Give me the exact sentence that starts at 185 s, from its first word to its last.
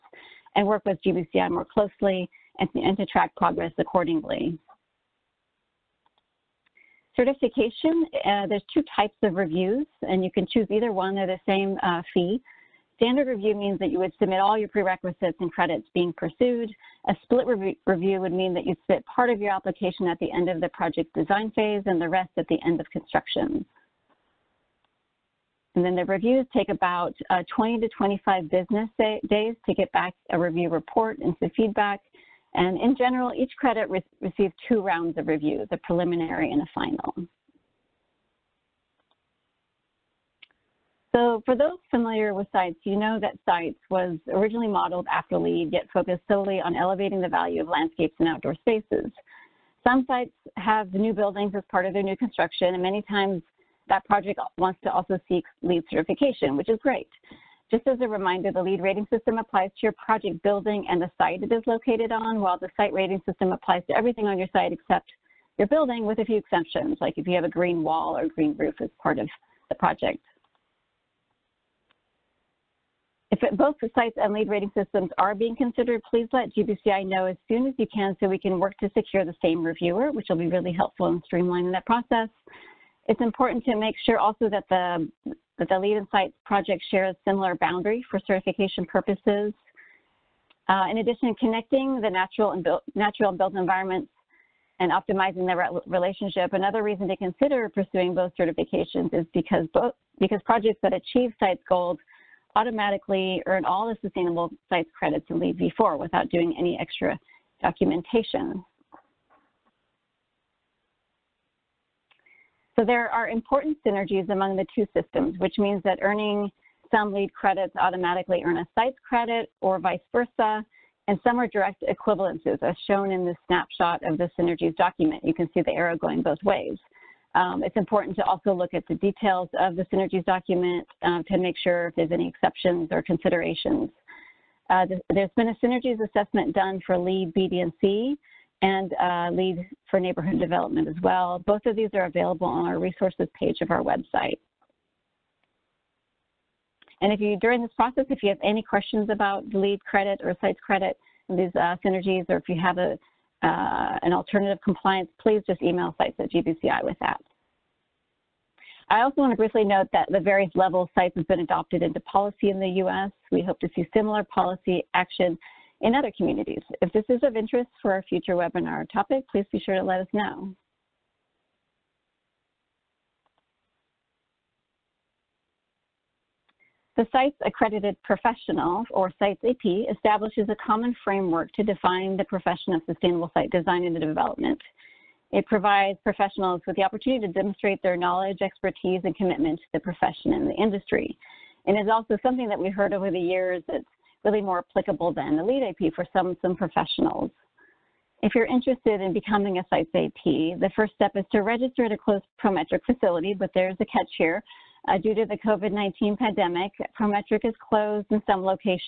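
It provides professionals with the opportunity to demonstrate their knowledge, expertise, and commitment to the profession and the industry.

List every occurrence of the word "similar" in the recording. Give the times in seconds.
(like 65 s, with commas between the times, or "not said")
87 s, 163 s.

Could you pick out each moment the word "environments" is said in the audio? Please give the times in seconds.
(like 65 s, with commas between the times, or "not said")
93 s.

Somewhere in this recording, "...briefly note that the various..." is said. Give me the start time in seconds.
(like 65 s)
159 s.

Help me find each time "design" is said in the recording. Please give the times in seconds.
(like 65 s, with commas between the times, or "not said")
21 s, 183 s.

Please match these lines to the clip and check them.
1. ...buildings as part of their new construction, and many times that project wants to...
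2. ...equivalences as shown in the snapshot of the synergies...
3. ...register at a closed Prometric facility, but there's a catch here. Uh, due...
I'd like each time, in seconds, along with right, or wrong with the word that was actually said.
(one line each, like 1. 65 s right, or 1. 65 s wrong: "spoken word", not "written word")
1. 51 s right
2. 121 s right
3. 201 s right.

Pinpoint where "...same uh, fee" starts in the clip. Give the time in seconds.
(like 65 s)
11 s.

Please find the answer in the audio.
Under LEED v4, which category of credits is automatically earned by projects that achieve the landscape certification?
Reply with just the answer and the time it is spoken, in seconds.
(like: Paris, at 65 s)
sustainable sites credits, at 104 s.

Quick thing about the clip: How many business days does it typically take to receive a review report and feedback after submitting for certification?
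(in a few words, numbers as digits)
20 to 25.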